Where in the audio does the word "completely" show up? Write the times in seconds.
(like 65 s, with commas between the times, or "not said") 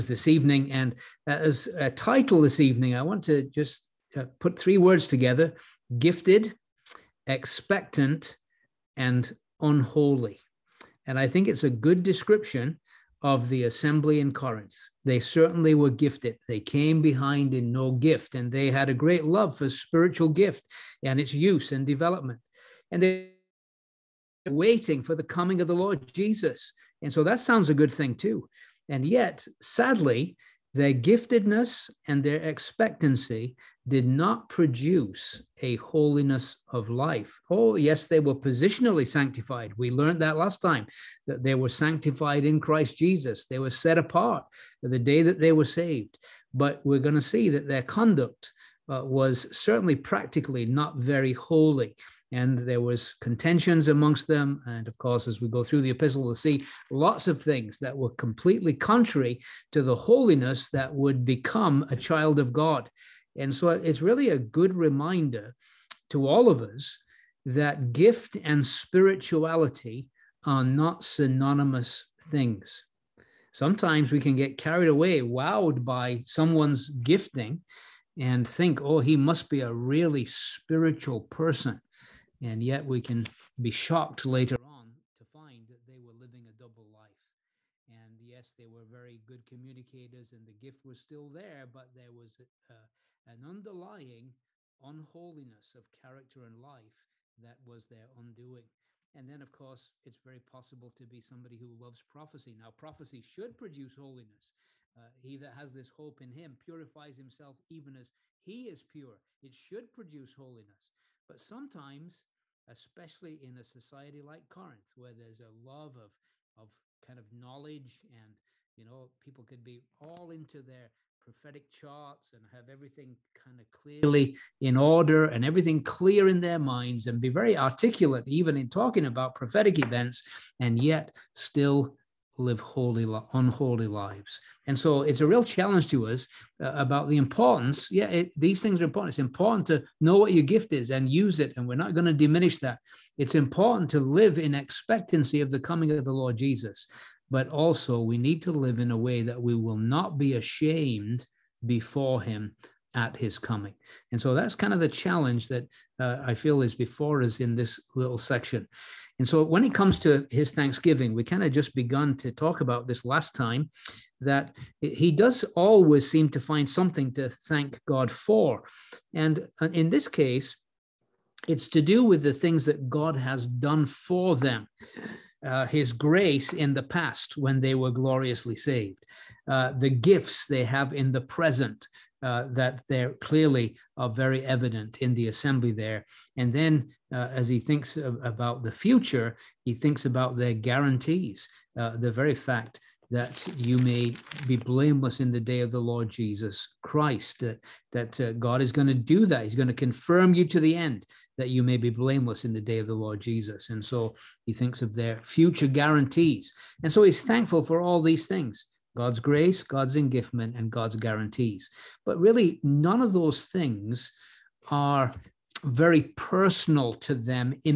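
58 s.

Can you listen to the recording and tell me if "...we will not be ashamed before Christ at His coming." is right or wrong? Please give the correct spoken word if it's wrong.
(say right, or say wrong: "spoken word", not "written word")
wrong: "Him", not "Christ".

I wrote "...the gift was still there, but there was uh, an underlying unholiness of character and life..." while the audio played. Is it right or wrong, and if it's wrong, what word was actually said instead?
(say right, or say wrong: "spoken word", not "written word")
right.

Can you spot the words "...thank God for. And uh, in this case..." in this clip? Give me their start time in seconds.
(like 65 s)
167 s.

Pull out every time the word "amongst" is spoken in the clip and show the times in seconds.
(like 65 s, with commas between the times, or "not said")
53 s.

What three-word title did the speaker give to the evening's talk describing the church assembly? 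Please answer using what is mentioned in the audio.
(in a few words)
Gifted, expectant, and unholy.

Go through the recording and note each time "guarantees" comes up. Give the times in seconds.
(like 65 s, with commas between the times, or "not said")
190 s, 205 s, 210 s.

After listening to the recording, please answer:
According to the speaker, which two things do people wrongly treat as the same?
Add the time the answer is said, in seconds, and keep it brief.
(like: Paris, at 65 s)
Gift and spirituality, at 67 s.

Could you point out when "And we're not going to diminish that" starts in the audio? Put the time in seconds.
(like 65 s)
141 s.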